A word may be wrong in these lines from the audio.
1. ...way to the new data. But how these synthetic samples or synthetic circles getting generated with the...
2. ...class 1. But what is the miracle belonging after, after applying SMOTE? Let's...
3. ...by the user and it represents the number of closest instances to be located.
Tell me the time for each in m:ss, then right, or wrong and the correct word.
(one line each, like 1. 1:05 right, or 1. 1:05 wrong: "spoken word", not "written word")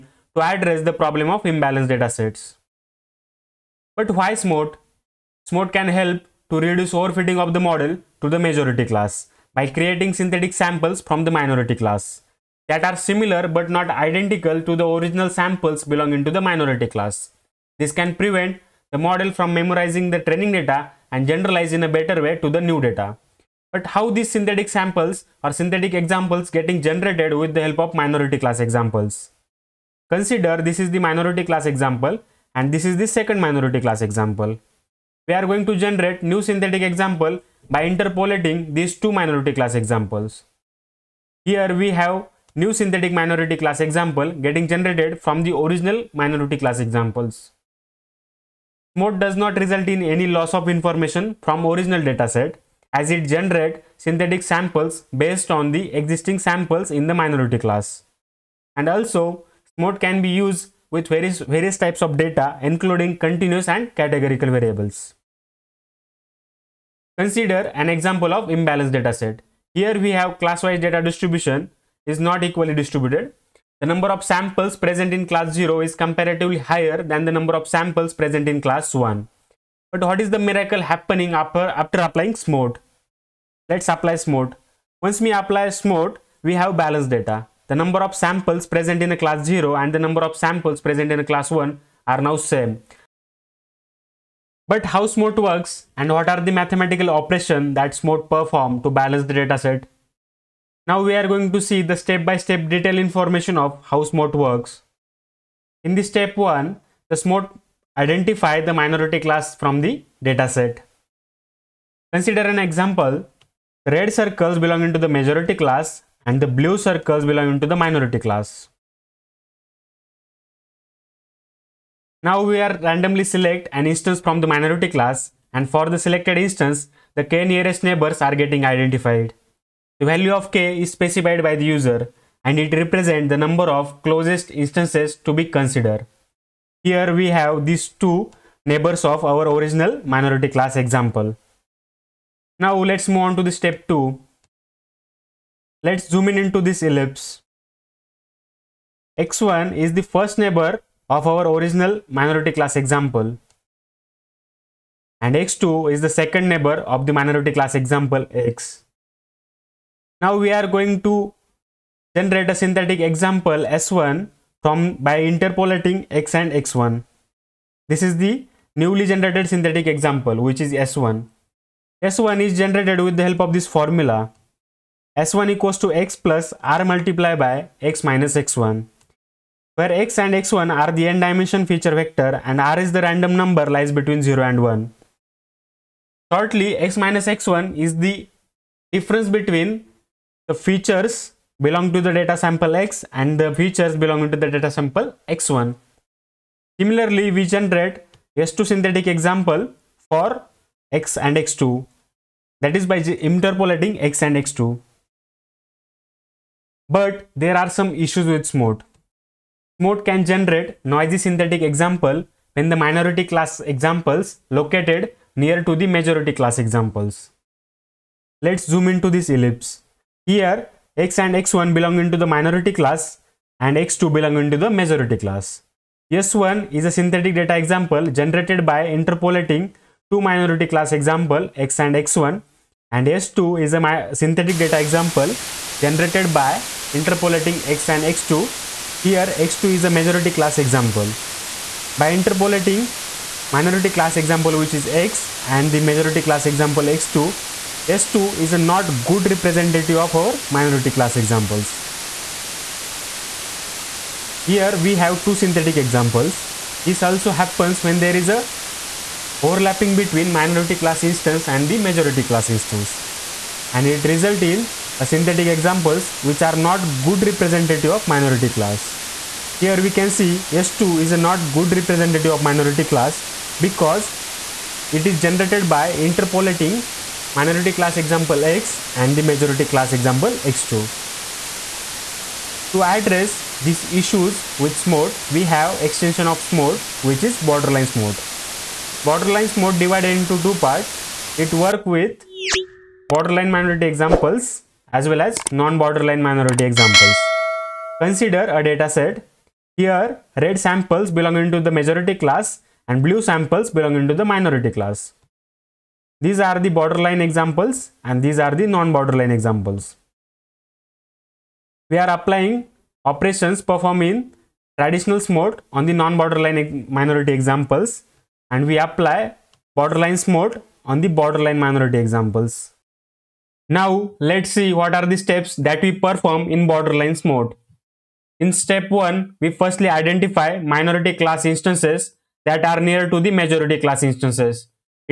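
1. 0:22 wrong: "examples", not "circles"
2. 1:18 wrong: "happening", not "belonging"
3. 2:11 wrong: "considered", not "located".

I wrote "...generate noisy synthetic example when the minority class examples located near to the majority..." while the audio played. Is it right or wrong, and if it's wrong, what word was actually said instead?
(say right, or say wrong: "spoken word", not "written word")
right.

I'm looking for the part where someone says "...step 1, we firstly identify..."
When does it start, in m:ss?
5:28.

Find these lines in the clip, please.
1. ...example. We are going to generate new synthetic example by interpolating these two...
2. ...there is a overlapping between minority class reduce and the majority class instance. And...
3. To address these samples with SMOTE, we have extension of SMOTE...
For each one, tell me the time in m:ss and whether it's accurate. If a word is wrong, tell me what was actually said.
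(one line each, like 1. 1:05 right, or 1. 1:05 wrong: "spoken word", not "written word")
1. 0:34 right
2. 4:17 wrong: "instance", not "reduce"
3. 4:42 wrong: "issues", not "samples".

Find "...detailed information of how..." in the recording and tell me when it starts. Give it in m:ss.
1:42.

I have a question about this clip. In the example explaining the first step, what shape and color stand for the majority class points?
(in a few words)
Red circles.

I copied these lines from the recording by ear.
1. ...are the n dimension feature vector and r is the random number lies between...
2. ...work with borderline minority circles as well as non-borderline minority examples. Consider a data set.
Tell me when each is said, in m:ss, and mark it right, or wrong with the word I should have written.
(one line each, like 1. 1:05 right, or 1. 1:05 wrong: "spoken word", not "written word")
1. 3:00 right
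2. 4:51 wrong: "examples", not "circles".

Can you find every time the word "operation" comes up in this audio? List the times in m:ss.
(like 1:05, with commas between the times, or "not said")
1:37, 5:13.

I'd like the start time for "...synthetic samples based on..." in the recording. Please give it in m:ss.
0:53.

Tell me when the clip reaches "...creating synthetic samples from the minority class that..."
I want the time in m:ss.
0:09.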